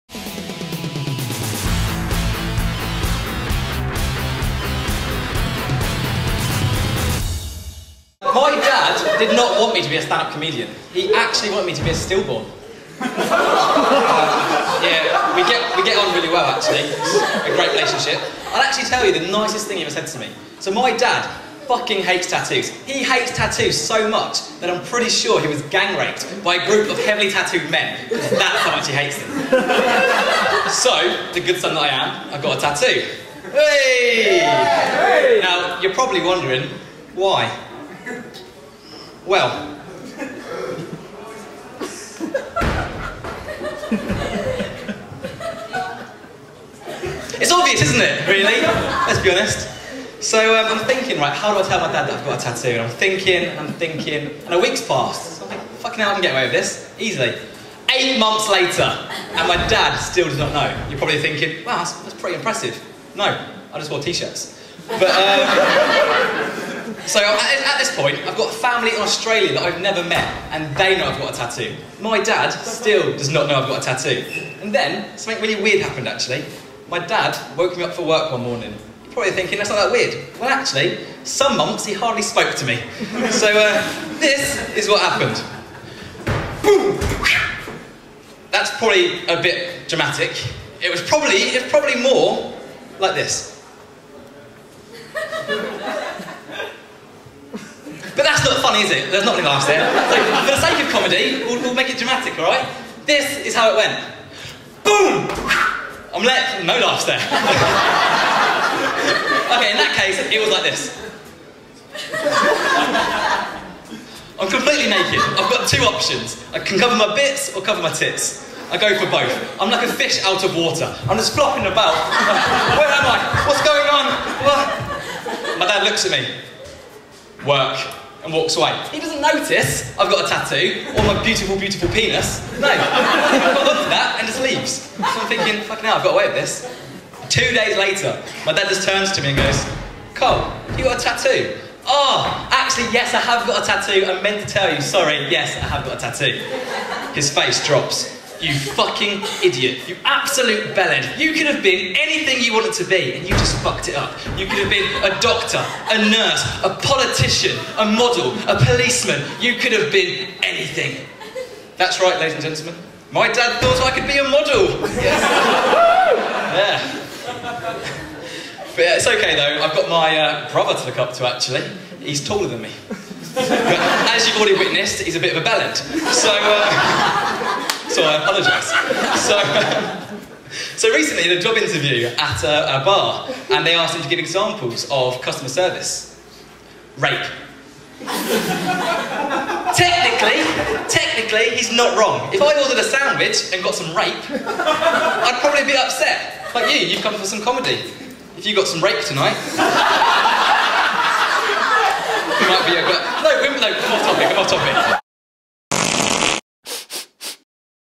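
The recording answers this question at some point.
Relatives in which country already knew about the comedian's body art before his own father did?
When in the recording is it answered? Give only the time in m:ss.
1:09.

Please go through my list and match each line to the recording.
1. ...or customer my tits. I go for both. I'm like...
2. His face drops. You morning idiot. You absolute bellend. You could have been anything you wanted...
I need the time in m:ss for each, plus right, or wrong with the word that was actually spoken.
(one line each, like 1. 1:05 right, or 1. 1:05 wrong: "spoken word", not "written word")
1. 1:57 wrong: "cover", not "customer"
2. 2:27 wrong: "fucking", not "morning".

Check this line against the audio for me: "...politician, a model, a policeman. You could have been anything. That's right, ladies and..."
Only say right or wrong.
right.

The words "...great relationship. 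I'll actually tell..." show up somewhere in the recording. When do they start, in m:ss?
0:17.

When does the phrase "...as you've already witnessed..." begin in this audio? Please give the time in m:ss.
2:54.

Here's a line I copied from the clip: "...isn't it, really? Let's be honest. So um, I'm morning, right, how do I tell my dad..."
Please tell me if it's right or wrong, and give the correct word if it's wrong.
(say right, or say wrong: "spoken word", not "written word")
wrong: "thinking", not "morning".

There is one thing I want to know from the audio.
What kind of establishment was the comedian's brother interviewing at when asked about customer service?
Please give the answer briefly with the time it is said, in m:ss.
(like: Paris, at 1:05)
A bar, at 3:02.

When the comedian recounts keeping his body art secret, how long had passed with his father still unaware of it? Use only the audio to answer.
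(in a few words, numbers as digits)
8 months.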